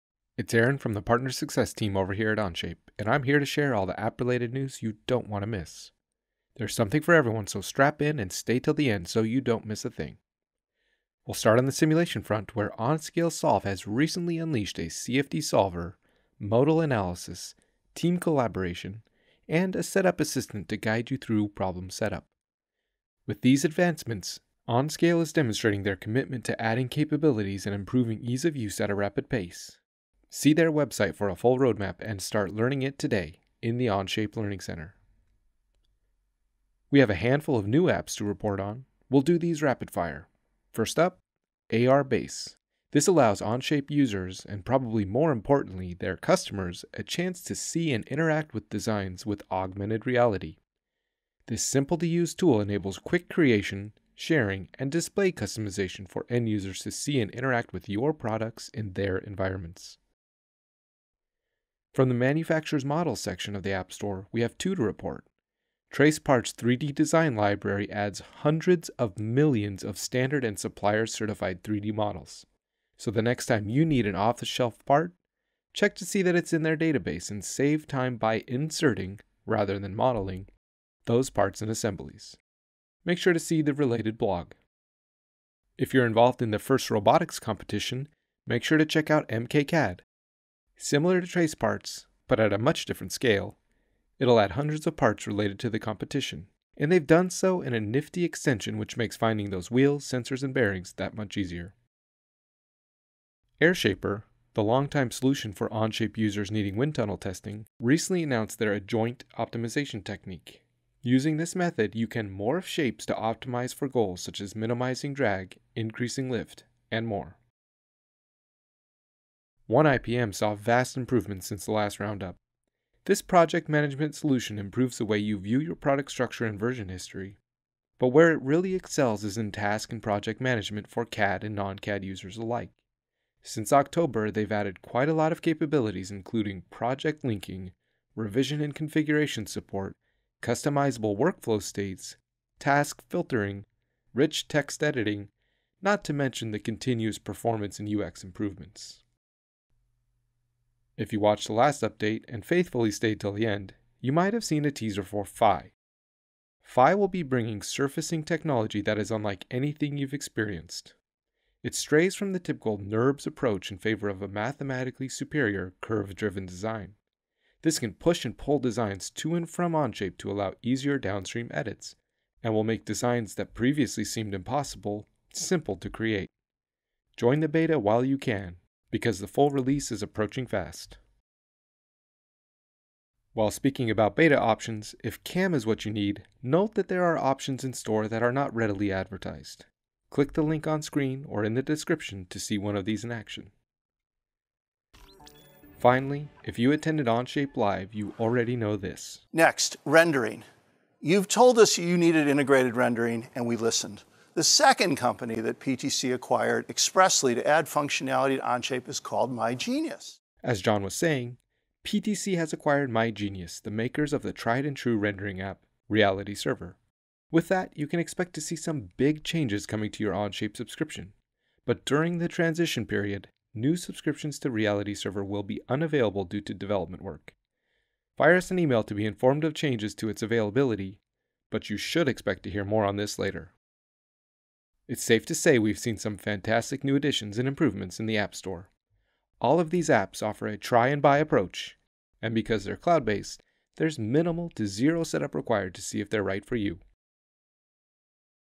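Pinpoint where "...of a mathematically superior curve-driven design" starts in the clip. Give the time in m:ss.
2:44.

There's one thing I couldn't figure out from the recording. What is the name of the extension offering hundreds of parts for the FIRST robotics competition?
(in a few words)
MKCAD.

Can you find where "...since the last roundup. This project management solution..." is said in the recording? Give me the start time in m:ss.
2:01.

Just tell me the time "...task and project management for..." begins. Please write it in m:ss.
2:09.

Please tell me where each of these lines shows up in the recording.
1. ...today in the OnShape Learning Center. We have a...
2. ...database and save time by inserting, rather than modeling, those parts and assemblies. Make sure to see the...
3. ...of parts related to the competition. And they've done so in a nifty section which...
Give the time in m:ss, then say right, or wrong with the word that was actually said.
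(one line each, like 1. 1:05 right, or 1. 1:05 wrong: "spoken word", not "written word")
1. 0:32 right
2. 1:16 right
3. 1:34 wrong: "extension", not "section".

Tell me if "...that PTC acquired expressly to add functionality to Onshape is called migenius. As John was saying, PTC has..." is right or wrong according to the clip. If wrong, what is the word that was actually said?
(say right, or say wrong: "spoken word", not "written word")
right.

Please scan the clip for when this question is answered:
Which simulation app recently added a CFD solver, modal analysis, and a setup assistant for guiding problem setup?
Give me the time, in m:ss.
0:12.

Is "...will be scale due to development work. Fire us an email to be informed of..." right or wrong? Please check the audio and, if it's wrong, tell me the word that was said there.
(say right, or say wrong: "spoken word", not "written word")
wrong: "unavailable", not "scale".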